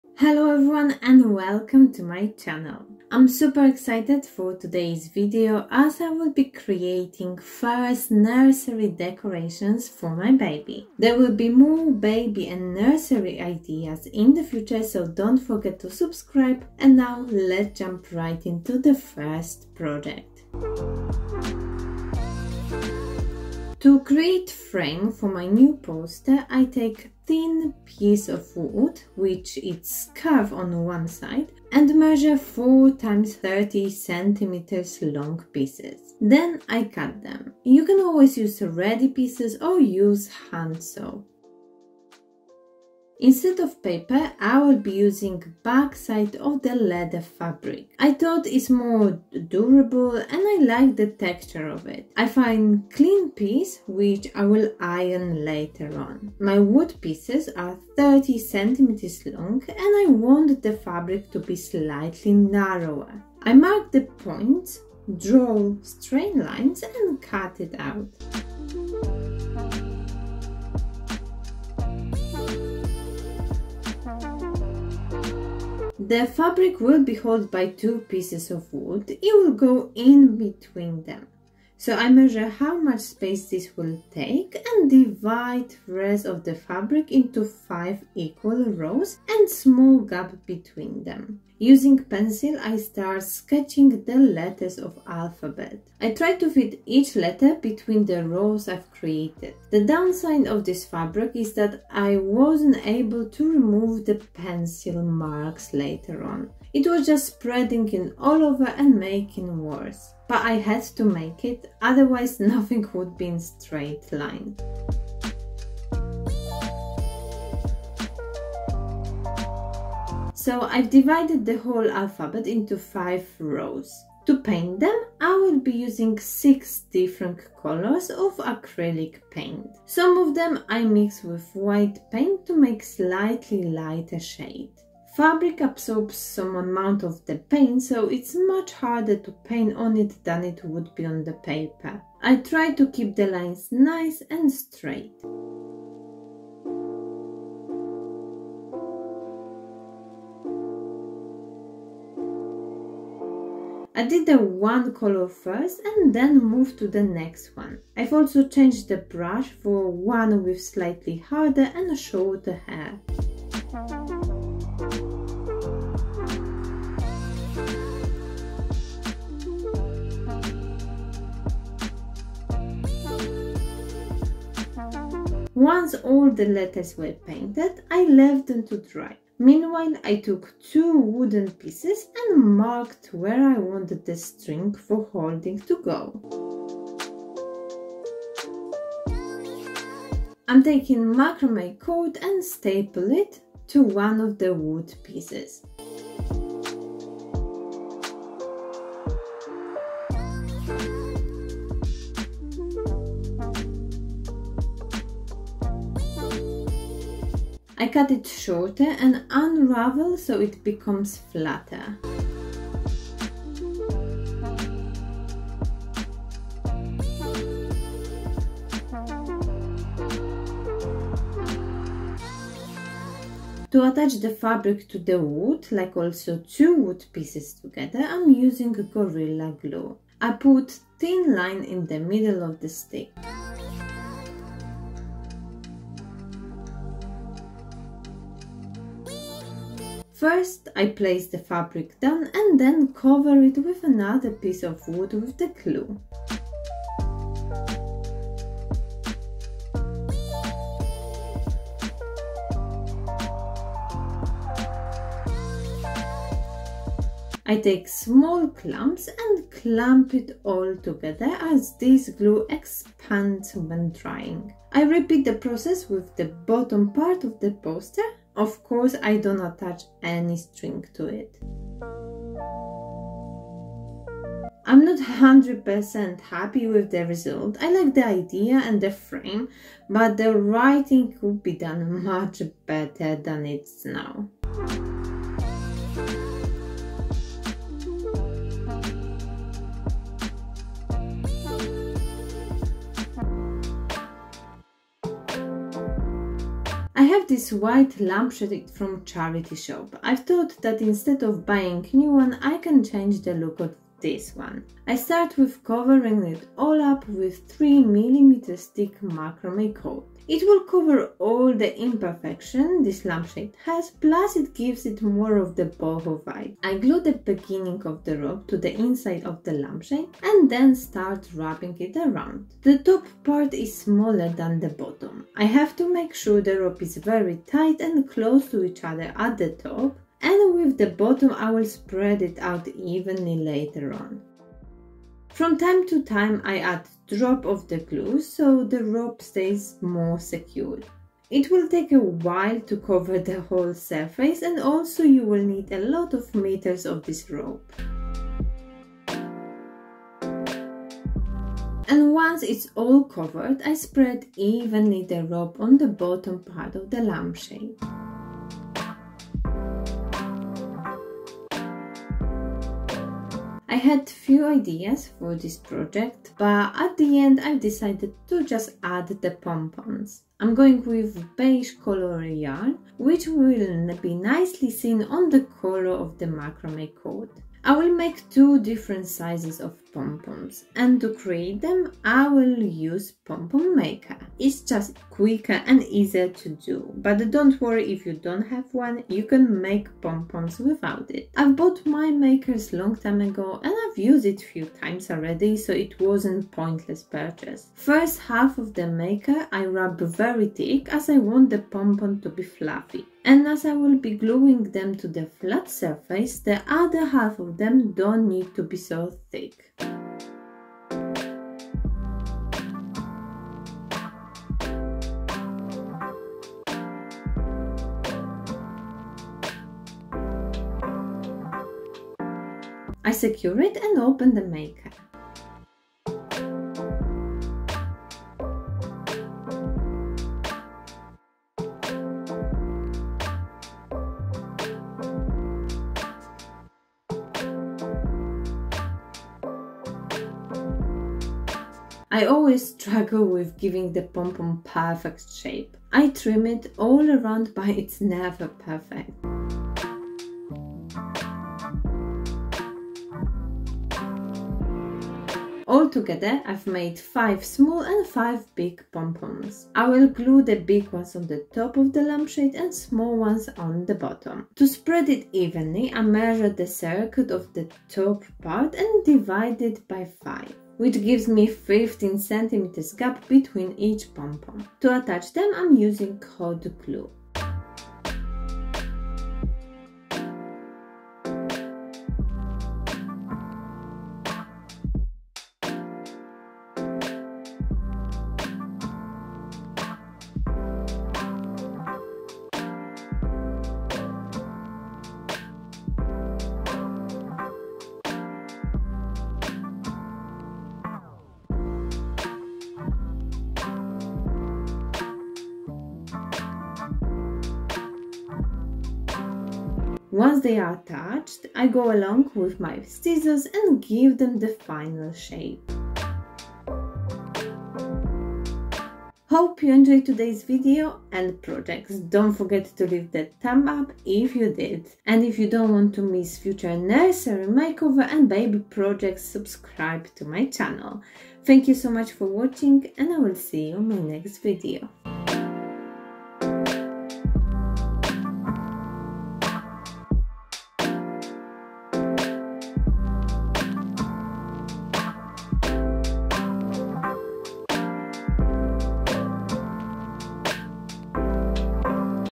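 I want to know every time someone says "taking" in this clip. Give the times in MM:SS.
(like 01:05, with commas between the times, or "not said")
03:10.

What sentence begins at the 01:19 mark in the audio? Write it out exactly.
It will go in between them.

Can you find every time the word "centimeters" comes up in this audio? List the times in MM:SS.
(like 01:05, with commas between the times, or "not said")
00:33, 00:58, 07:52.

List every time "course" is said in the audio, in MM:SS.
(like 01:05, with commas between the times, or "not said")
04:28.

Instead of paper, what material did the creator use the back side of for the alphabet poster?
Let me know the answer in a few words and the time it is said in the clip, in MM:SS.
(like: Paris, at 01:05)
leather fabric, at 00:46.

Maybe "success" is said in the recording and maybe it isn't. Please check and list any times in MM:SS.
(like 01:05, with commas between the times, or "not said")
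not said.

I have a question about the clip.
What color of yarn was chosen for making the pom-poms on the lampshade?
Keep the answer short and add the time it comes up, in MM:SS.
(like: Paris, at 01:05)
beige, at 06:11.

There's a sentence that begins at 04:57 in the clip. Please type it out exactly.
I have this white lampshade from charity shop.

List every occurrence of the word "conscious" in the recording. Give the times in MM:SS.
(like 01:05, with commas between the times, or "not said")
not said.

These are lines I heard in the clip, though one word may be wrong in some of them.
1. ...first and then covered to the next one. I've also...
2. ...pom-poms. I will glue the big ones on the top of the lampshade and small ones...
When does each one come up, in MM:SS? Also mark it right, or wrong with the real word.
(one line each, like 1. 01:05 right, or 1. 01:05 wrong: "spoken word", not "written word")
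1. 02:35 wrong: "moved", not "covered"
2. 07:38 right.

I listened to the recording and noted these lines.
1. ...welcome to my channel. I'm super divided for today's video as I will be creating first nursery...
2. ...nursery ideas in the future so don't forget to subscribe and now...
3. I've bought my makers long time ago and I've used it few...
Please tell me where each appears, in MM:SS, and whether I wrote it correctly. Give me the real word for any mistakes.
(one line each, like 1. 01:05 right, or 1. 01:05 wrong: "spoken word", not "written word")
1. 00:01 wrong: "excited", not "divided"
2. 00:12 right
3. 06:31 right.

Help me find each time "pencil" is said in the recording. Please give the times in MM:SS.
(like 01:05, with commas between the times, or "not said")
01:32, 01:44.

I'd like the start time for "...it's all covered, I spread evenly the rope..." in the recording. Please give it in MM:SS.
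05:52.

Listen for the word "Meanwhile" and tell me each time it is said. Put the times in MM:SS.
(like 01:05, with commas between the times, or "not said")
02:59.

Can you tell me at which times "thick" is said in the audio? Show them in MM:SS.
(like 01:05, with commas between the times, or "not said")
05:08, 06:40.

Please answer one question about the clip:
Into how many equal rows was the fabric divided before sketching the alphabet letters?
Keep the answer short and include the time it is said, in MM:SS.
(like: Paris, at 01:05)
5, at 01:27.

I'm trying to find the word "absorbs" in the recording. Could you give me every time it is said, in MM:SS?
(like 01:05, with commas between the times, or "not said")
02:15.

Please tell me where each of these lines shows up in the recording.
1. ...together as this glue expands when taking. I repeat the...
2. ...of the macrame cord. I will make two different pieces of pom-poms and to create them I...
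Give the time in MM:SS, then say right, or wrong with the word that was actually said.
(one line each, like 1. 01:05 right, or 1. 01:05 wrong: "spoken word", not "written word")
1. 04:20 wrong: "drying", not "taking"
2. 06:15 wrong: "sizes", not "pieces".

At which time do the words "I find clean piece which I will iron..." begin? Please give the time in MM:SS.
00:52.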